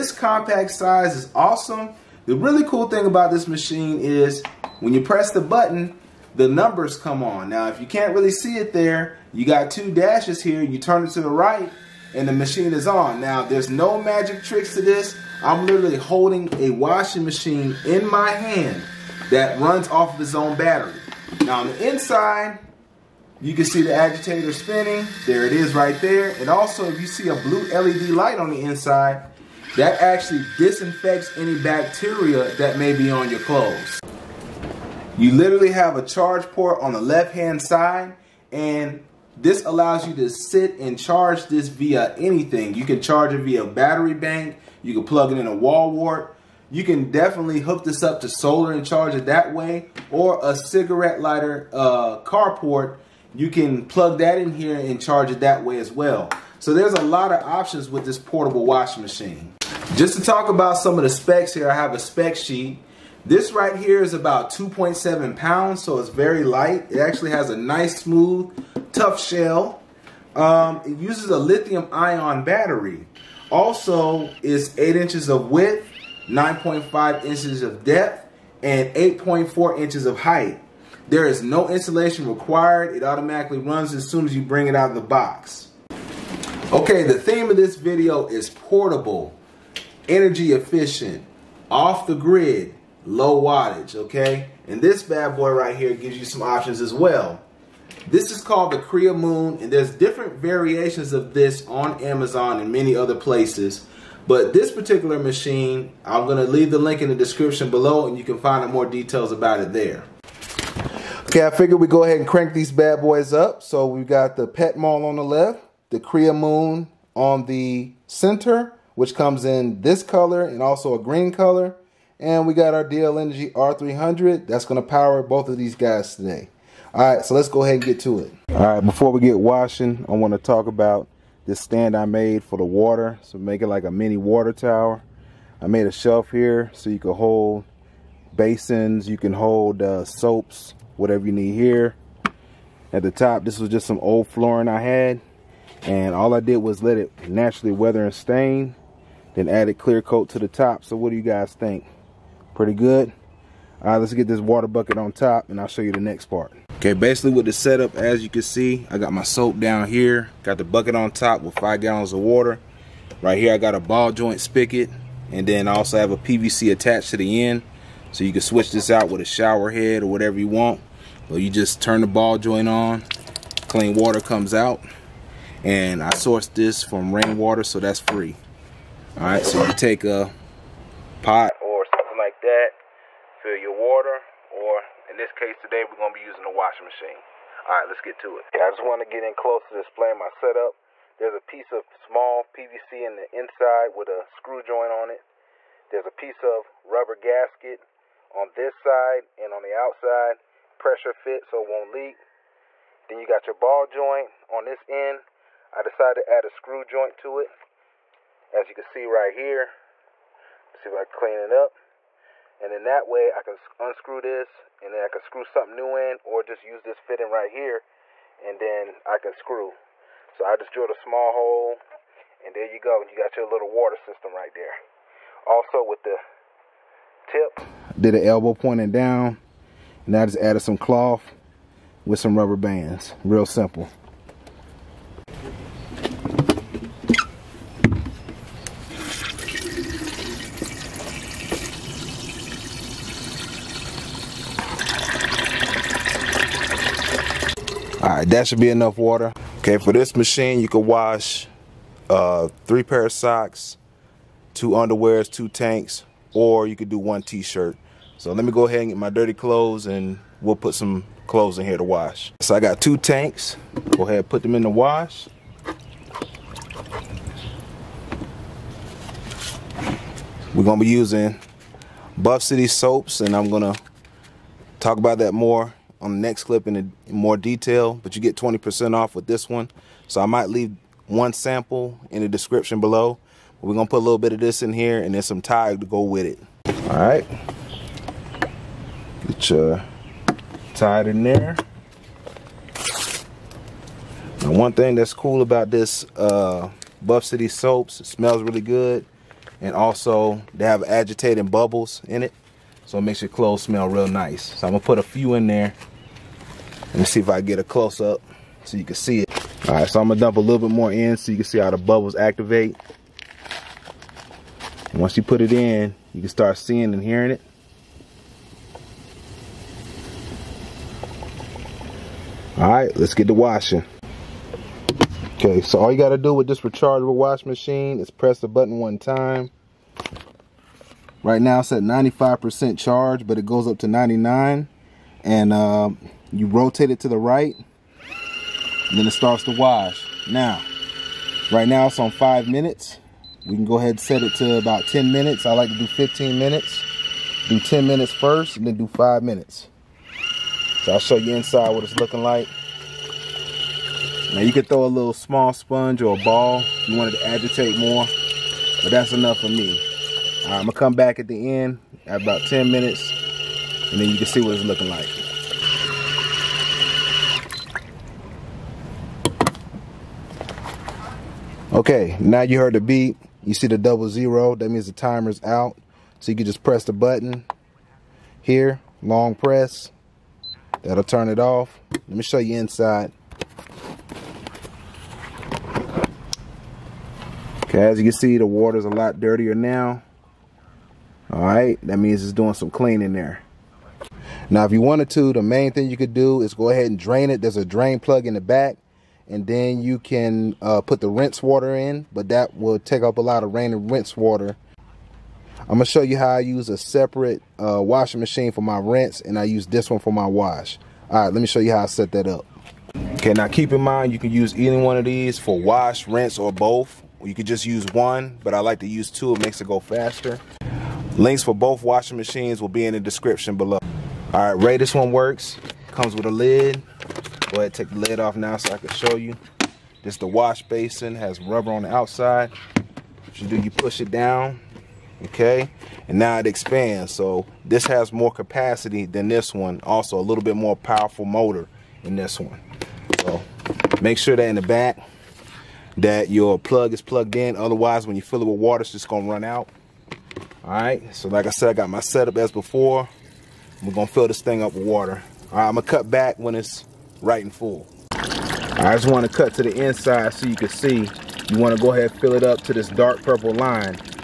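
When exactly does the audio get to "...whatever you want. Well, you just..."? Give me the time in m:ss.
2:50.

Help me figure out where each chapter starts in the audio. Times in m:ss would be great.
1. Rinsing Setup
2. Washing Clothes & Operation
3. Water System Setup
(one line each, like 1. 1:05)
1. 6:52
2. 4:08
3. 2:08.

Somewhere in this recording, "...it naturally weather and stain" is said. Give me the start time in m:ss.
2:26.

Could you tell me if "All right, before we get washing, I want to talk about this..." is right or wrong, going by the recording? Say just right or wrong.
right.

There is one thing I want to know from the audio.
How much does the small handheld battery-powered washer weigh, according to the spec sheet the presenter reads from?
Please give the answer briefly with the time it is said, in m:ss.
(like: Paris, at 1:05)
2.7 pounds, at 1:04.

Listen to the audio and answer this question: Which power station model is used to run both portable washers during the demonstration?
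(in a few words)
DL Energy R300.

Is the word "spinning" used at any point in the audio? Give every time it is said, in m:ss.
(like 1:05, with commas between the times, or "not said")
0:24.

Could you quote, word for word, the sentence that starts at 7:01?
Links for both washing machines will be in the description below.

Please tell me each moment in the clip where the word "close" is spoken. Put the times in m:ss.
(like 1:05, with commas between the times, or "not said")
3:09, 5:07.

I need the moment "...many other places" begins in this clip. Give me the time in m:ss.
1:42.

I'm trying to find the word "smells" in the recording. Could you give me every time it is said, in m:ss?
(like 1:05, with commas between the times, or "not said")
4:58, 5:03.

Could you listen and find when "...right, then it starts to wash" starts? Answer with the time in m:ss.
5:37.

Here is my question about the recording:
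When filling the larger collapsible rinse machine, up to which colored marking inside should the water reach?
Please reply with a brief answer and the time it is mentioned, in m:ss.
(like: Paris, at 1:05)
dark purple line, at 7:42.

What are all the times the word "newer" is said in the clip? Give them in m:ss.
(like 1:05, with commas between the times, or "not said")
not said.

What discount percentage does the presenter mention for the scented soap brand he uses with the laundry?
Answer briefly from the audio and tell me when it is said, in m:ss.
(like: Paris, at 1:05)
20%, at 4:38.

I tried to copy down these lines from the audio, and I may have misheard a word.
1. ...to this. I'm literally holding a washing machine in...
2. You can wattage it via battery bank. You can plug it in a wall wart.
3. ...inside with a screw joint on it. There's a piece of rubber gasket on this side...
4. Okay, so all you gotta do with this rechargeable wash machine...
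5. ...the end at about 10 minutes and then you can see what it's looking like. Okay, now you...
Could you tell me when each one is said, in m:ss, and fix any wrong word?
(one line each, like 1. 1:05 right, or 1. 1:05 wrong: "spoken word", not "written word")
1. 0:14 right
2. 0:42 wrong: "charge", not "wattage"
3. 3:13 right
4. 5:25 right
5. 6:01 right.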